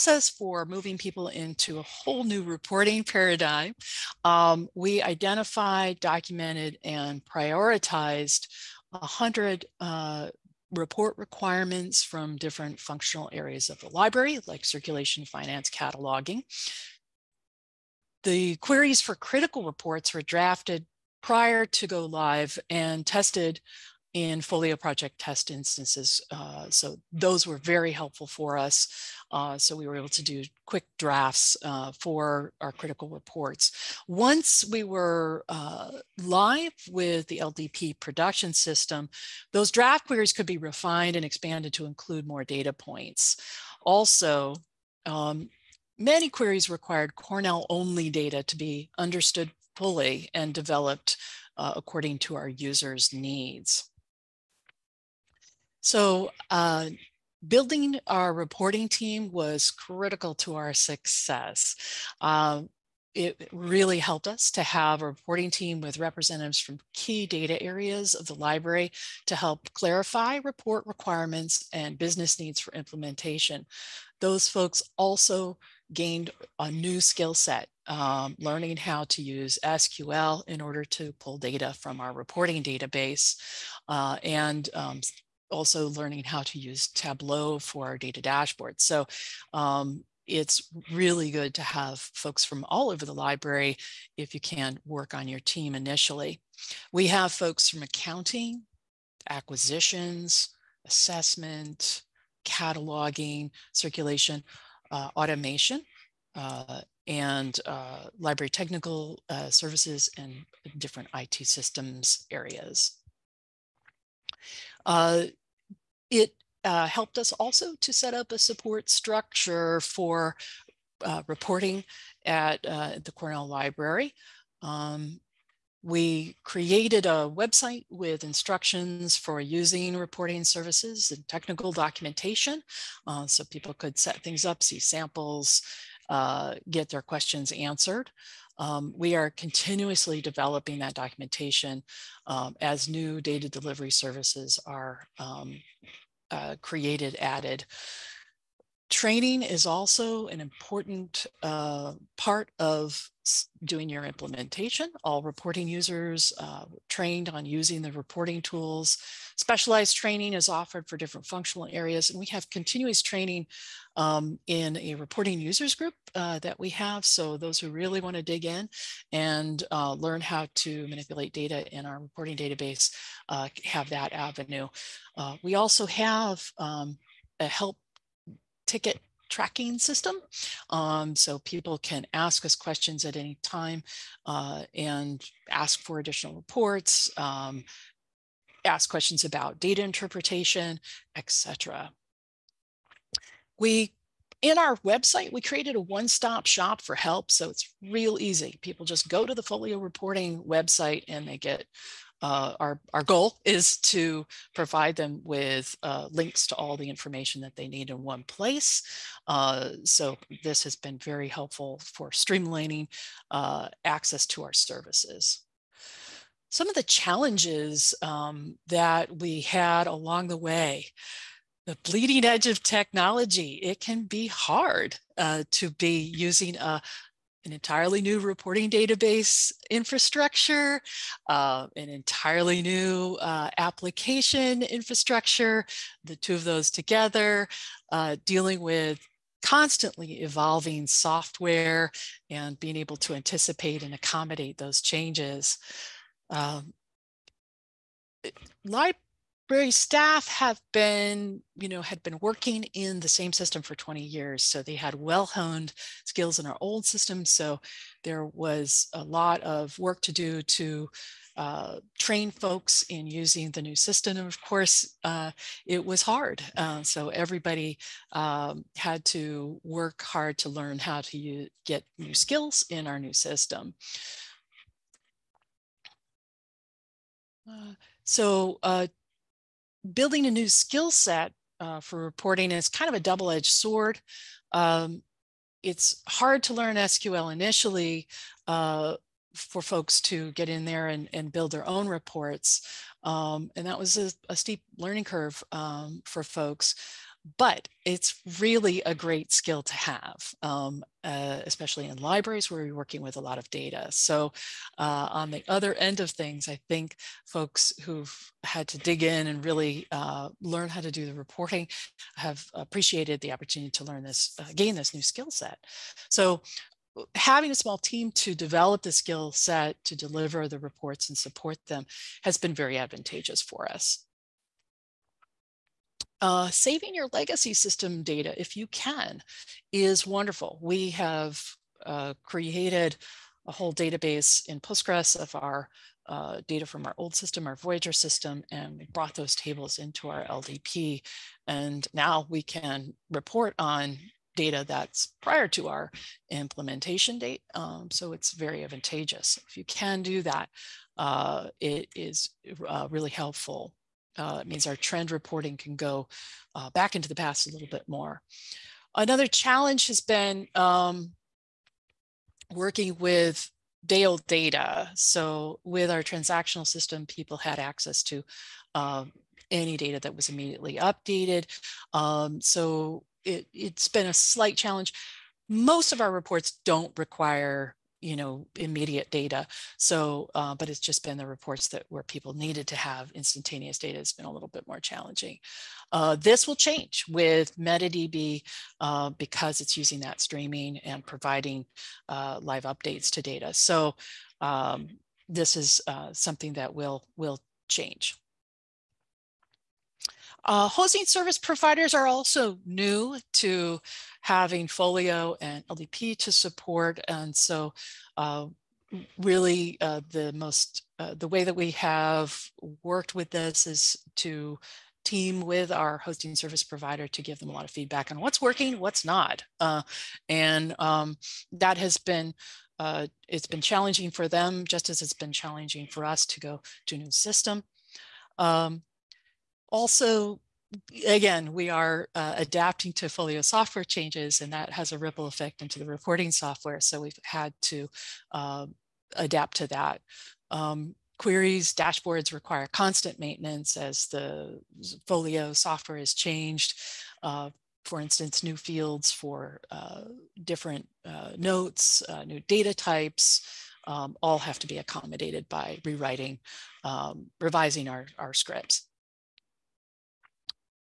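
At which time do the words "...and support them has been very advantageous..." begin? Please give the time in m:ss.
5:21.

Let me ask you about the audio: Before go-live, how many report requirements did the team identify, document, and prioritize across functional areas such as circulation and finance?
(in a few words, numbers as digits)
100.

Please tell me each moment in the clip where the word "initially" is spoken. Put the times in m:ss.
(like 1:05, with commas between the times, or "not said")
1:35, 4:47.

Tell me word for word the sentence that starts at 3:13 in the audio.
We in our website, we created a one-stop shop for help.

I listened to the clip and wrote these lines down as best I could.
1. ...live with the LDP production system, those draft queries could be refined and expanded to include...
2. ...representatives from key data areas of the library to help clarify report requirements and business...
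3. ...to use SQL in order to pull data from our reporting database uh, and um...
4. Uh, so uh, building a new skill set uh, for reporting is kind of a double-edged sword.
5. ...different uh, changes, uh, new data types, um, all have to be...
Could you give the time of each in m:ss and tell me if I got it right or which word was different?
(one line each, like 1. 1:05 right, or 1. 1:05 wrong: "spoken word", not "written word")
1. 0:36 right
2. 1:05 right
3. 1:19 right
4. 4:37 right
5. 7:30 wrong: "notes", not "changes".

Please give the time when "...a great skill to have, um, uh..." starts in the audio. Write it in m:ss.
4:58.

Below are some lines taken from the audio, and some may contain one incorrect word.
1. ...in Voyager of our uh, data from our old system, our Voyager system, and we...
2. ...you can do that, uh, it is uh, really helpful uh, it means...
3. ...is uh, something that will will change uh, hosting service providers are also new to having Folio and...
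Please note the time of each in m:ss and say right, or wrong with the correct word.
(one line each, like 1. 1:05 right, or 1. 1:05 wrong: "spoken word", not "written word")
1. 5:34 wrong: "Postgres", not "Voyager"
2. 5:49 right
3. 6:35 right.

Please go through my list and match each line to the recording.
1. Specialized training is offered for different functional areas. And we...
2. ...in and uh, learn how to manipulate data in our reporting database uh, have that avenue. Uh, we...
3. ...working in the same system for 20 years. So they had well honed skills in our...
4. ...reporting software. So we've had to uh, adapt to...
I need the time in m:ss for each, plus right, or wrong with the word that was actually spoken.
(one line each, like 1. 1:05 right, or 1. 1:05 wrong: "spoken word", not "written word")
1. 2:39 right
2. 2:48 right
3. 4:12 right
4. 7:15 right.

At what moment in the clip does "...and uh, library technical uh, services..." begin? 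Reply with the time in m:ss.
1:47.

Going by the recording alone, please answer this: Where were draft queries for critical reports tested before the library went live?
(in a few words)
Folio project test instances.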